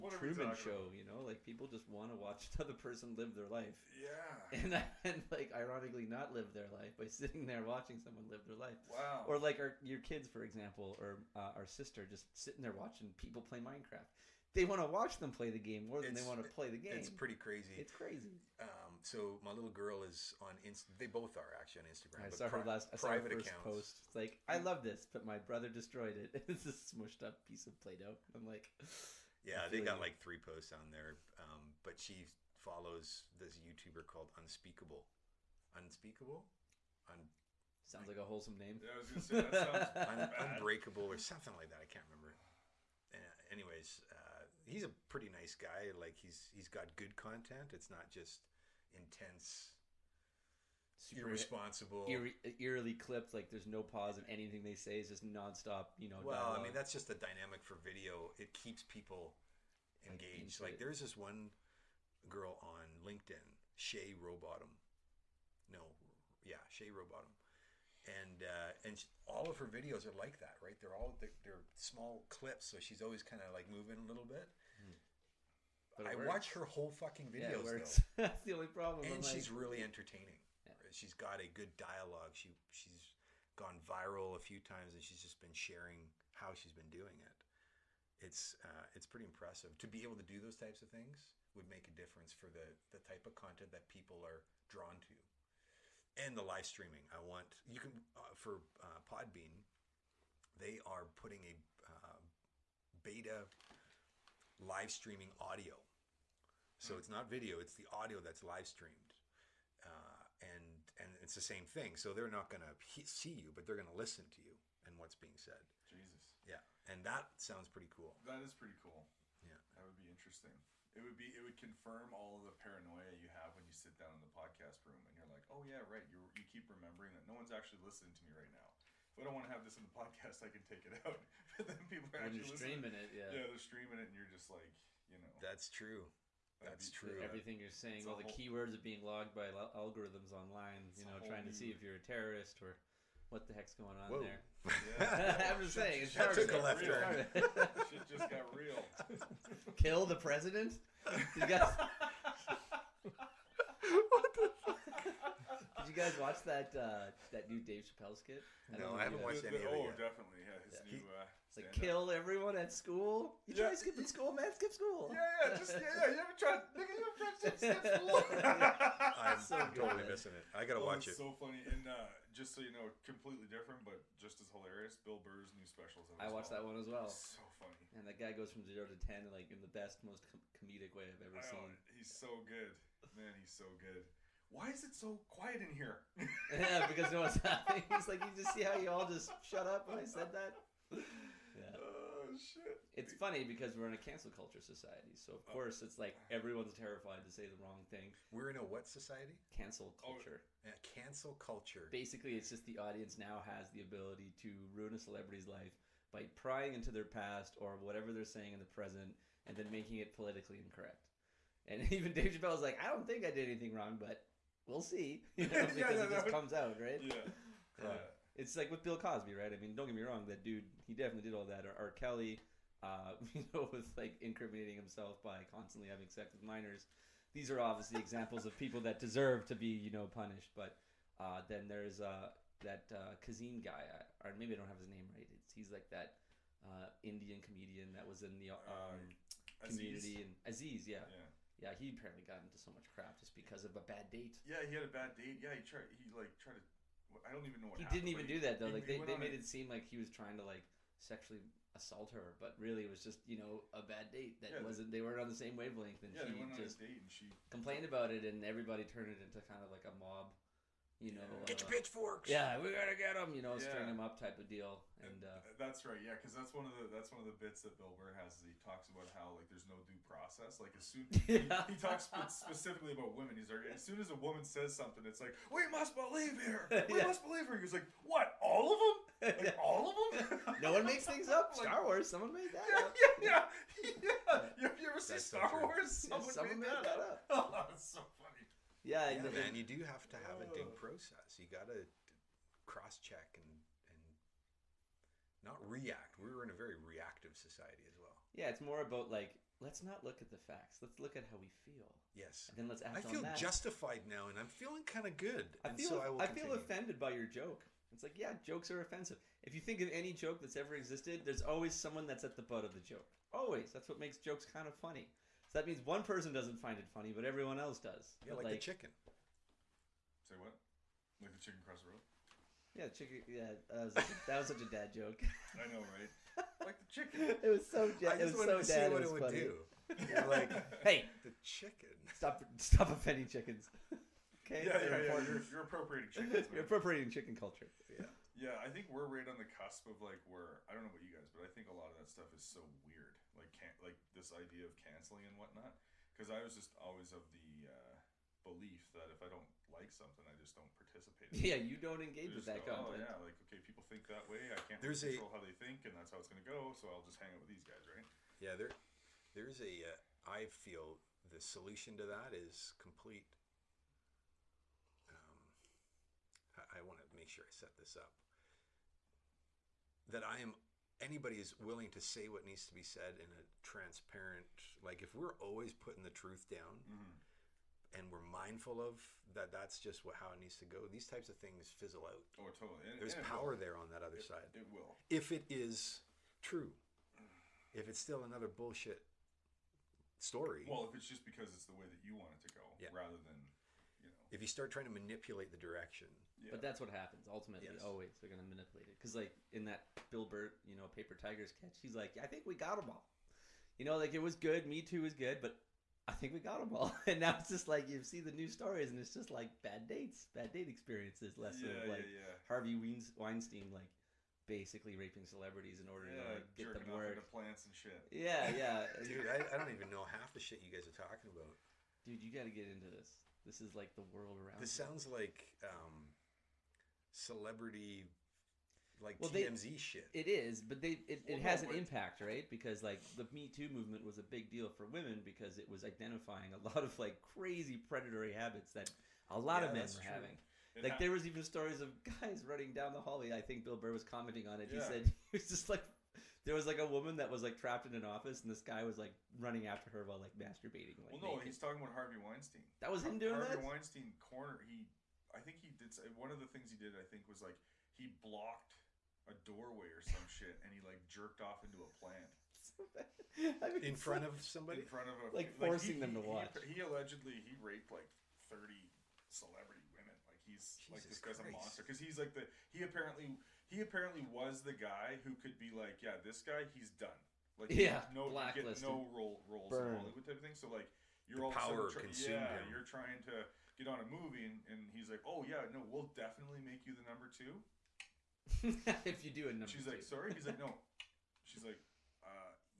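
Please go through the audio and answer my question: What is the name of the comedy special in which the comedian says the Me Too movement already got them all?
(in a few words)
Paper Tigers.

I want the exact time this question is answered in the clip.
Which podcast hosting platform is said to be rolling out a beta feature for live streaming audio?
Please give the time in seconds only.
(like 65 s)
99 s.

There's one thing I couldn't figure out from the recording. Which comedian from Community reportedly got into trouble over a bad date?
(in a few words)
Aziz.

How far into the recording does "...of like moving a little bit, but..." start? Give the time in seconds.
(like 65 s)
73 s.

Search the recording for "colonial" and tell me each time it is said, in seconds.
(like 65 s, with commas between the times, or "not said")
not said.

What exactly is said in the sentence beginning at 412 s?
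Harvey Weinstein, like basically raping celebrities in order to like, get them work.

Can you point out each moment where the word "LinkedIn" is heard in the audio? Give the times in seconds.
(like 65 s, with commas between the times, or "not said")
63 s.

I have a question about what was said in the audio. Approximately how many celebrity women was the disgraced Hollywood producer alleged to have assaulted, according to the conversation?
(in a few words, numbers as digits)
30.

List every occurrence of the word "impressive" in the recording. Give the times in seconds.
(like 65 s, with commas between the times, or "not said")
89 s.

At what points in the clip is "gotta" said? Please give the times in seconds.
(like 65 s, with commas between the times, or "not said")
170 s, 262 s.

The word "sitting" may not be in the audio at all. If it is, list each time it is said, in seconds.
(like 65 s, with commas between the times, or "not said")
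7 s, 12 s.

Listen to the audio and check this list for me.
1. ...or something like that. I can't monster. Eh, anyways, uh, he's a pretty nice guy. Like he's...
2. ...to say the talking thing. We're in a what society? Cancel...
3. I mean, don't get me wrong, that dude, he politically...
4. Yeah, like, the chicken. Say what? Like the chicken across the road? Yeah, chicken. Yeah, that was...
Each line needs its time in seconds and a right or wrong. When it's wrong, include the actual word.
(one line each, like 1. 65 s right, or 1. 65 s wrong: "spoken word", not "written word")
1. 41 s wrong: "remember", not "monster"
2. 197 s wrong: "wrong", not "talking"
3. 219 s wrong: "definitely", not "politically"
4. 318 s right.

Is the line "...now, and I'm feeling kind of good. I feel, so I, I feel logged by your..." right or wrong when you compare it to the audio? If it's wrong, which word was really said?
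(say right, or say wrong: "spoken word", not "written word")
wrong: "offended", not "logged".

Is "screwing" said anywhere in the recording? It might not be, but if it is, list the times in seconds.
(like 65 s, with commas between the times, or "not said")
not said.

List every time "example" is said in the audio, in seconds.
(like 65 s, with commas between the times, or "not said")
10 s, 227 s.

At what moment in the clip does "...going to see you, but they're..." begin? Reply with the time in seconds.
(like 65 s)
112 s.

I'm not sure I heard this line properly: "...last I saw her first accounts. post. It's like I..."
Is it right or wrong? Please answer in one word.
right.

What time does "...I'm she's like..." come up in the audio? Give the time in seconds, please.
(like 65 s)
79 s.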